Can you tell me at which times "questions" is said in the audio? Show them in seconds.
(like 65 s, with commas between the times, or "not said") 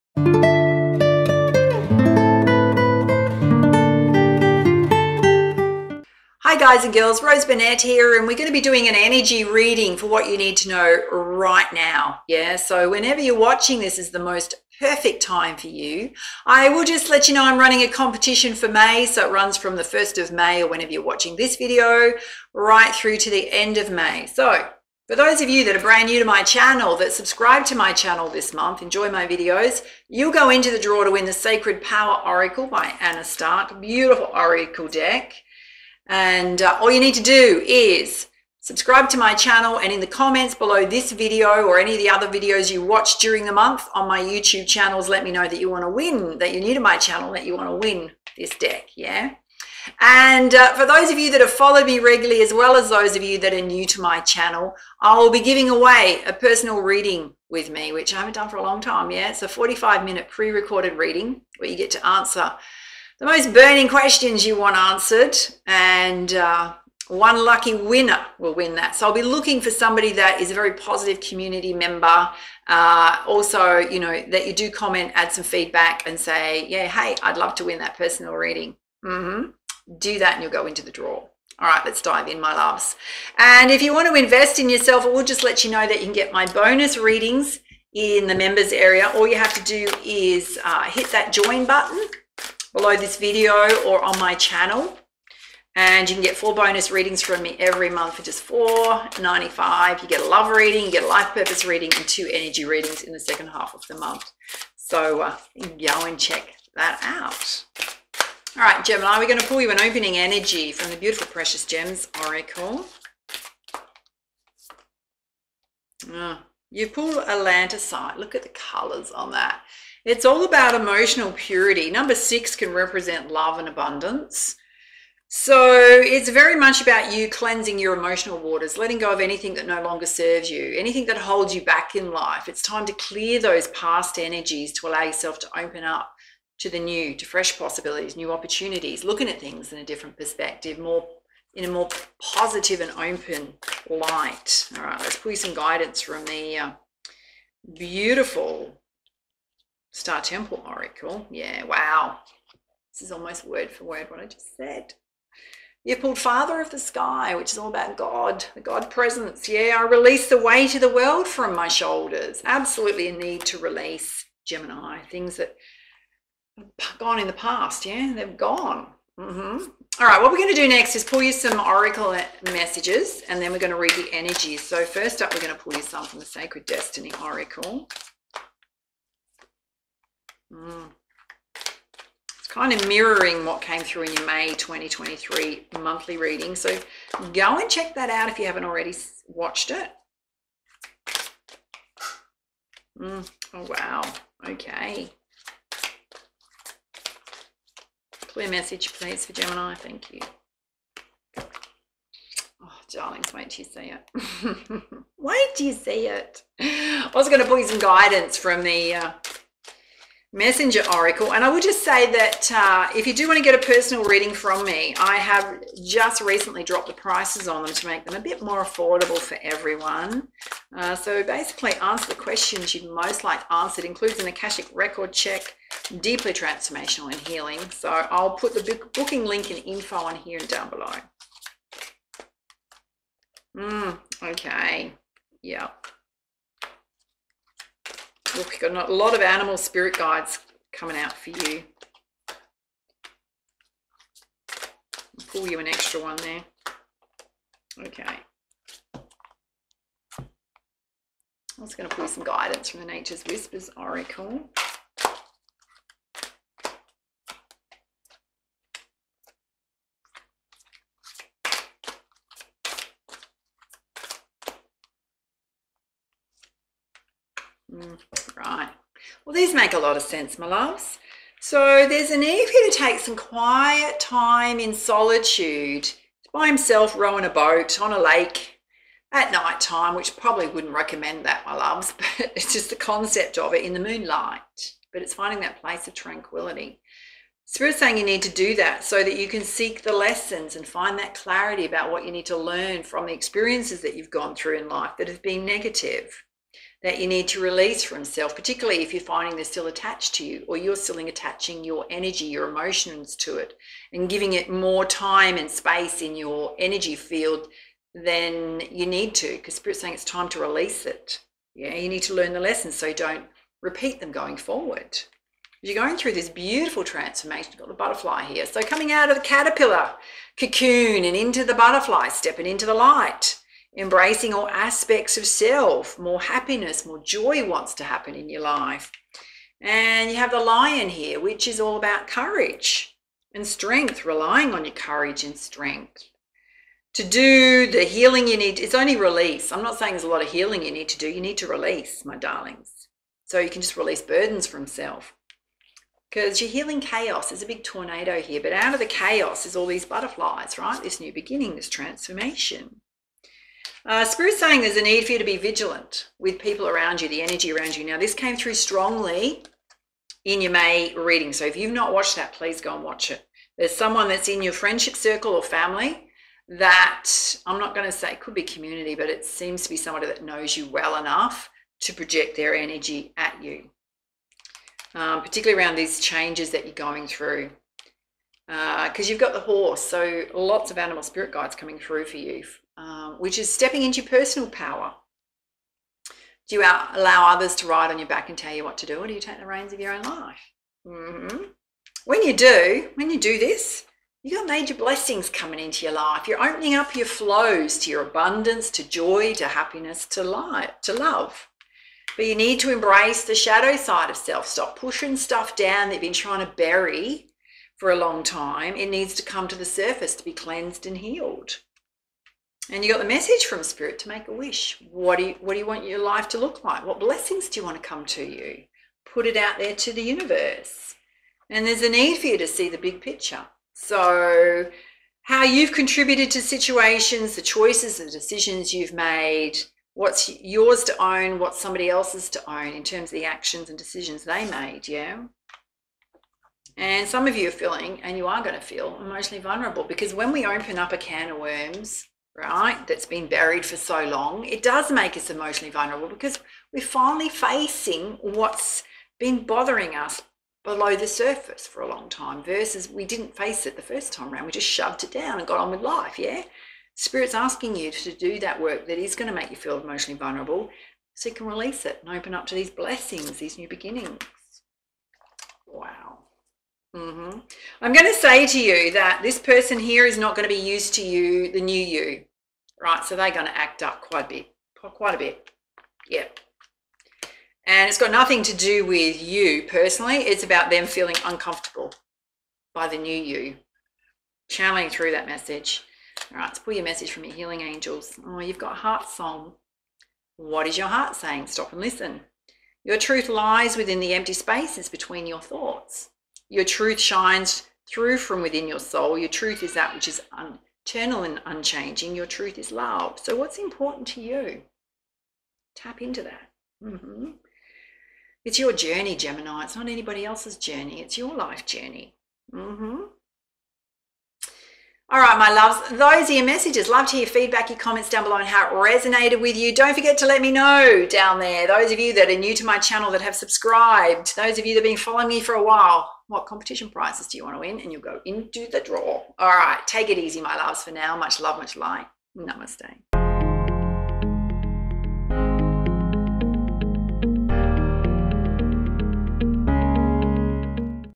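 63 s, 222 s.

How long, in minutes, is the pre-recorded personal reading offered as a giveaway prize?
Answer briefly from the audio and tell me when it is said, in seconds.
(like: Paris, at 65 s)
45, at 59 s.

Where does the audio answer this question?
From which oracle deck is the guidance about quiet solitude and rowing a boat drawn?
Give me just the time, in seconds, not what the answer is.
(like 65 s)
252 s.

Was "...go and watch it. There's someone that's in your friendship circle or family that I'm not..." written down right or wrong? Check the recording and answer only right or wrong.
right.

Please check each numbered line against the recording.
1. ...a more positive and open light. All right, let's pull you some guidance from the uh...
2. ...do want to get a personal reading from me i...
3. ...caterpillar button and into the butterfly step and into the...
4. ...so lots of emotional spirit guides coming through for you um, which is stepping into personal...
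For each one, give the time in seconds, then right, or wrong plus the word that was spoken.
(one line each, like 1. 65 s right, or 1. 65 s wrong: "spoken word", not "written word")
1. 141 s right
2. 213 s right
3. 319 s wrong: "cocoon", not "button"
4. 379 s wrong: "animal", not "emotional".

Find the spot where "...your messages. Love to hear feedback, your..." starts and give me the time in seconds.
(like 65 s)
516 s.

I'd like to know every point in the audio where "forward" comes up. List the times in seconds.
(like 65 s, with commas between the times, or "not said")
314 s.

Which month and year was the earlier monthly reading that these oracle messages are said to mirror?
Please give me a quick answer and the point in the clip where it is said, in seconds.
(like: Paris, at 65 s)
May 2023, at 184 s.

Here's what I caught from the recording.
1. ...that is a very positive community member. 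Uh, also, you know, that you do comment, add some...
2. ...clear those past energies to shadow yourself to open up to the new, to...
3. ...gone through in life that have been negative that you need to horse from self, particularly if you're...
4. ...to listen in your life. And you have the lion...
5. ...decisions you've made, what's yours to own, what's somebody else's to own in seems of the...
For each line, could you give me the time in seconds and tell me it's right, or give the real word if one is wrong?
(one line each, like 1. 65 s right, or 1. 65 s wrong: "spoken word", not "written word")
1. 70 s right
2. 132 s wrong: "allow", not "shadow"
3. 294 s wrong: "release", not "horse"
4. 327 s wrong: "happen", not "listen"
5. 428 s wrong: "terms", not "seems".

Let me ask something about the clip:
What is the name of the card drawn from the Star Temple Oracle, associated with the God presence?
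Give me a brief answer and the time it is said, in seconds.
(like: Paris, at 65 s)
Father of the Sky, at 156 s.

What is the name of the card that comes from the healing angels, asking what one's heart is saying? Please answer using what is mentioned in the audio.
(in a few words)
Heart Song.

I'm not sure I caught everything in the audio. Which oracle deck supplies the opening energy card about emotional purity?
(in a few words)
Precious Gems Oracle.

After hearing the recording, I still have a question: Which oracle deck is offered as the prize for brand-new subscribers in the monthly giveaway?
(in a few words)
Sacred Power Oracle.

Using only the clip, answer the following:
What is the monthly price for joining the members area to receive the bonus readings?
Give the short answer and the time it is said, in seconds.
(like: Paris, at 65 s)
$4.95, at 98 s.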